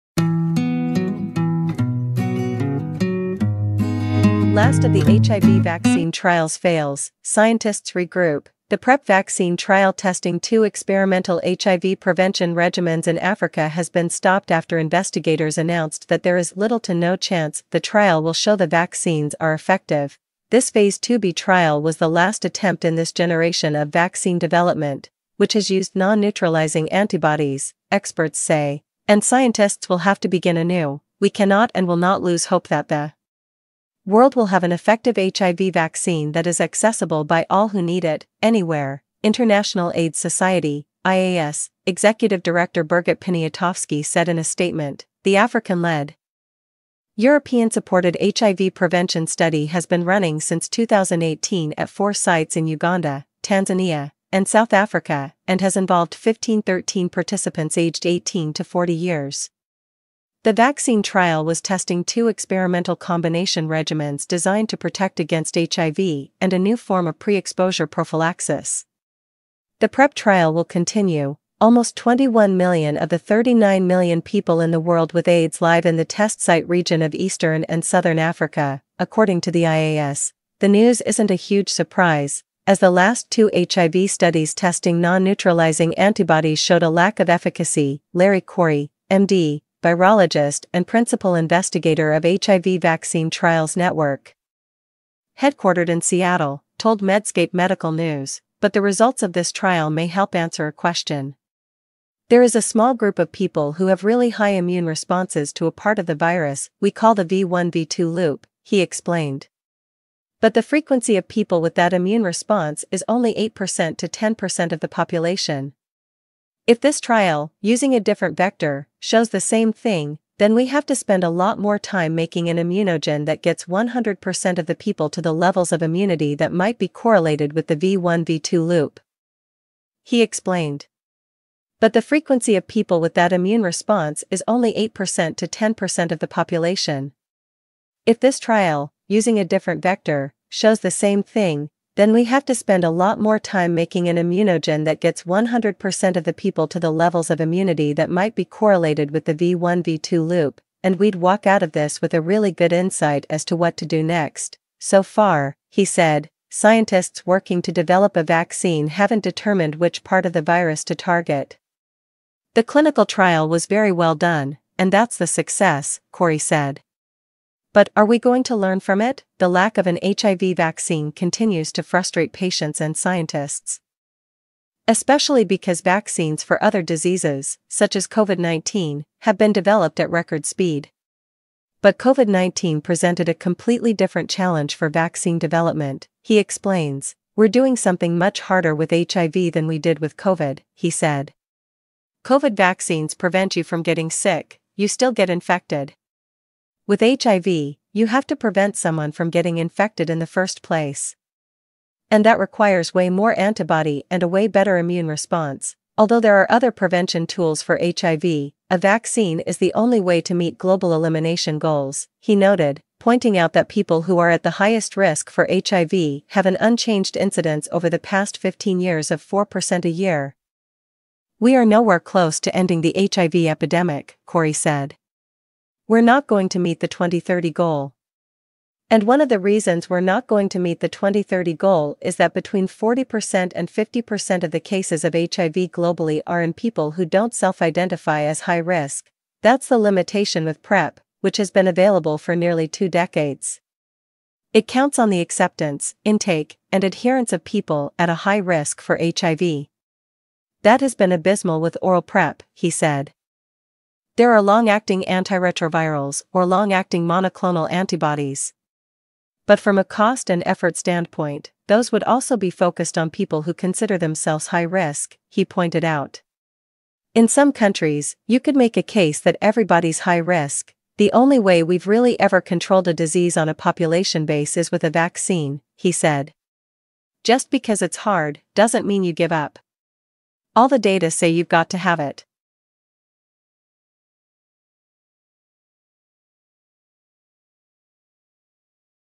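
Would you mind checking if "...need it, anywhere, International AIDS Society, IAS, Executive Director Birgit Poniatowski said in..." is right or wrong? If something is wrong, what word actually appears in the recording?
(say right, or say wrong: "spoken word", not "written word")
right.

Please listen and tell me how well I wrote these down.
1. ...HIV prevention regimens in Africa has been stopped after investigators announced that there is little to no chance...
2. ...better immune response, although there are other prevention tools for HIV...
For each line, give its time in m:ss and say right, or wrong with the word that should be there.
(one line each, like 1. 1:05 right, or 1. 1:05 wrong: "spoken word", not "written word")
1. 0:11 right
2. 3:24 right.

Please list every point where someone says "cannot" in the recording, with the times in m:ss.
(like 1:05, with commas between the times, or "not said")
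0:31.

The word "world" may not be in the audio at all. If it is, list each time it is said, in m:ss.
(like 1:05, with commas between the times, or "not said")
0:34, 1:14.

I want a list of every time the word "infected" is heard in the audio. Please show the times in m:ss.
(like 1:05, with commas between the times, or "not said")
3:15, 3:19.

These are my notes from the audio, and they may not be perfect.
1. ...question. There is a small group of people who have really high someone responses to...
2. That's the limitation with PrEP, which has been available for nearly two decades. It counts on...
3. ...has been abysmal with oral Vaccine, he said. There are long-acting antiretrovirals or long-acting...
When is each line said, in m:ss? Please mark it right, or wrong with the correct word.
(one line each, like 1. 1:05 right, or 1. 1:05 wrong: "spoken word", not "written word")
1. 1:40 wrong: "immune", not "someone"
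2. 3:59 right
3. 4:10 wrong: "PrEP", not "Vaccine".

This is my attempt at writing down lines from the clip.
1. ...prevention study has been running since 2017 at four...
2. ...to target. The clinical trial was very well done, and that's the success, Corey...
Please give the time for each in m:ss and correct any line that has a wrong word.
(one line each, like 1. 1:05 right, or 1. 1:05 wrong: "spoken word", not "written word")
1. 0:48 wrong: "2018", not "2017"
2. 2:40 right.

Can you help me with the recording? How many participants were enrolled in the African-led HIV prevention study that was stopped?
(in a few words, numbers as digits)
1513.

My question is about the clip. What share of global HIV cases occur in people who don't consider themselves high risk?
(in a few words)
40% to 50%.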